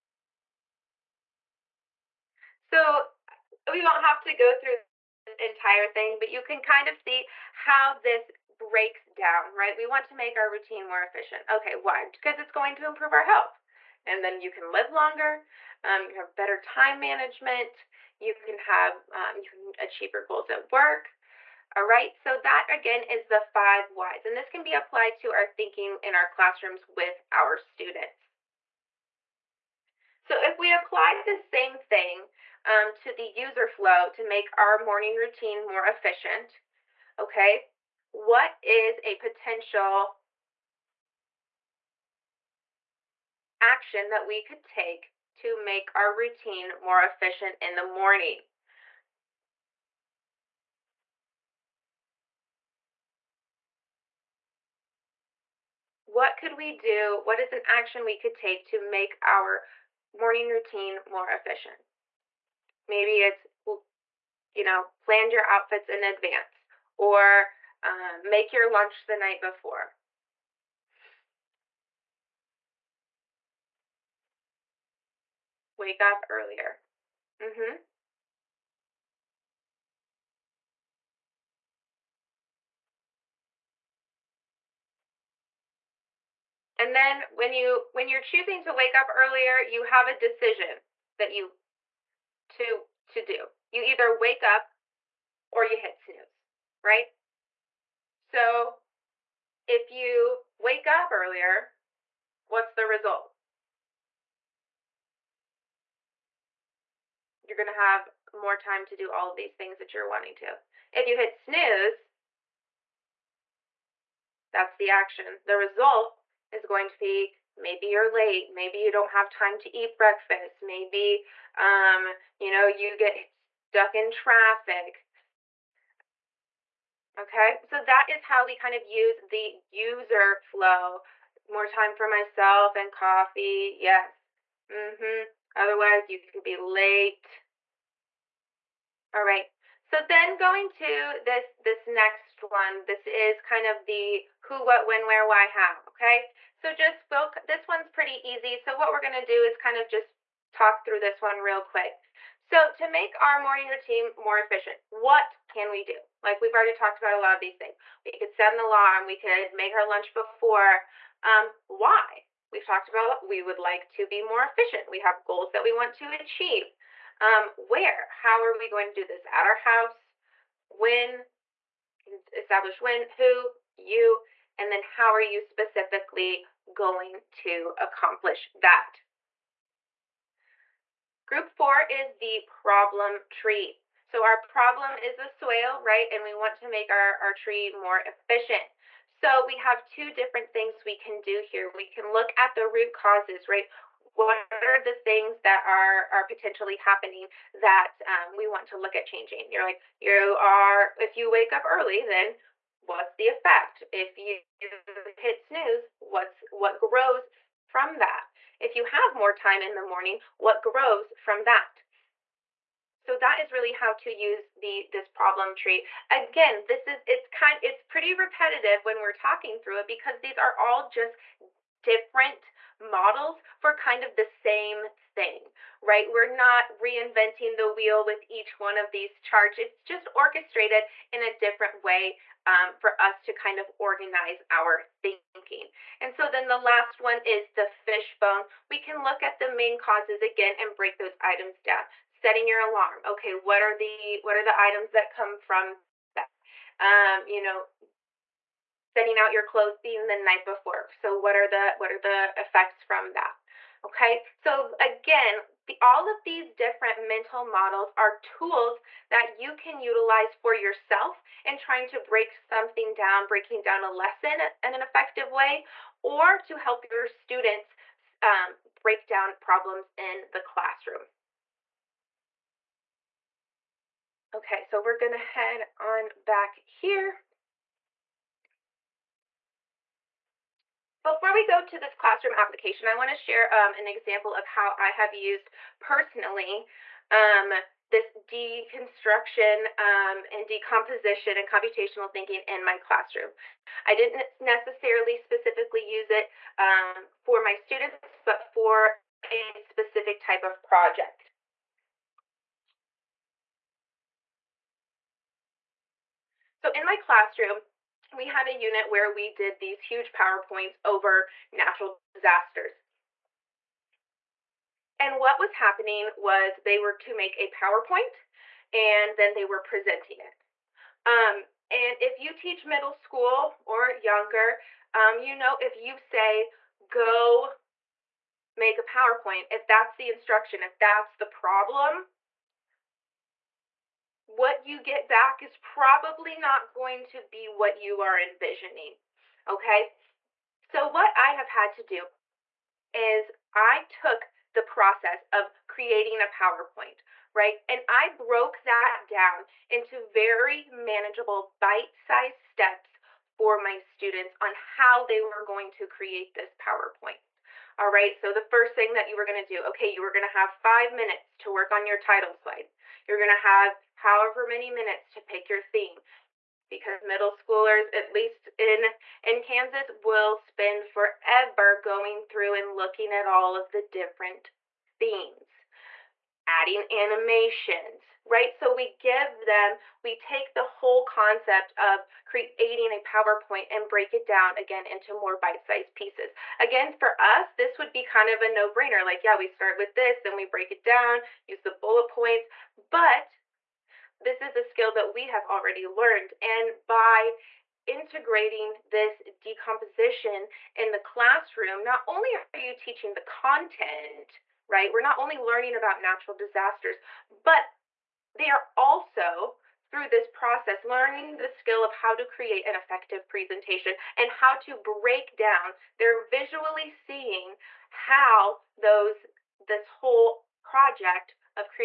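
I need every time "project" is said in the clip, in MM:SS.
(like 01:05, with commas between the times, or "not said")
05:00, 07:00.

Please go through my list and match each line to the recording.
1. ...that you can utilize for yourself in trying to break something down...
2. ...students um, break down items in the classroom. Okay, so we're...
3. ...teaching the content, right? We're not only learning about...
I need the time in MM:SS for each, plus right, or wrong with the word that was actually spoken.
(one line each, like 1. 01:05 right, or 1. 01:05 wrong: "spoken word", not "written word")
1. 04:19 right
2. 04:27 wrong: "problems", not "items"
3. 06:42 right.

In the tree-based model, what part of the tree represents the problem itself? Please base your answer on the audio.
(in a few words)
the soil.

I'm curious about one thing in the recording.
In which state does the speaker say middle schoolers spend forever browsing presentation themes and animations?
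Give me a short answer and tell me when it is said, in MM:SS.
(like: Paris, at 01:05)
Kansas, at 06:09.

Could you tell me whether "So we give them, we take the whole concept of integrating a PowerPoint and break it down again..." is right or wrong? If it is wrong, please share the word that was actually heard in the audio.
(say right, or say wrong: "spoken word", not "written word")
wrong: "creating", not "integrating".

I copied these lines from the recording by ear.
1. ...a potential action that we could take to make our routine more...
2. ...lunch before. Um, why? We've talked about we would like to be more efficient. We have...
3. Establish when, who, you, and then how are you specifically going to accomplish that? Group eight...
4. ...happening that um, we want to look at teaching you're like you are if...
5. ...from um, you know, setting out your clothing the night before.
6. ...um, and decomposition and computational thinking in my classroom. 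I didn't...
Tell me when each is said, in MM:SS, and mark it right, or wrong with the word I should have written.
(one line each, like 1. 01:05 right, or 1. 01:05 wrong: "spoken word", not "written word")
1. 00:39 right
2. 02:39 right
3. 02:52 wrong: "four", not "eight"
4. 03:16 wrong: "changing", not "teaching"
5. 04:05 right
6. 04:49 right.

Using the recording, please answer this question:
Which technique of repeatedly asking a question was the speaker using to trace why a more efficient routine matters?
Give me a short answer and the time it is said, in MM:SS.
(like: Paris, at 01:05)
five whys, at 00:23.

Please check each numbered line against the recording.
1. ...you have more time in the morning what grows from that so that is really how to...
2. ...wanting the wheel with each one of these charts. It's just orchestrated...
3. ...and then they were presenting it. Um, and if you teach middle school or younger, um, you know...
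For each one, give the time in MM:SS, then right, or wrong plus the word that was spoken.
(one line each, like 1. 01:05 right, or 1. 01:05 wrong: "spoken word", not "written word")
1. 03:28 right
2. 03:46 wrong: "reinventing", not "wanting"
3. 05:18 right.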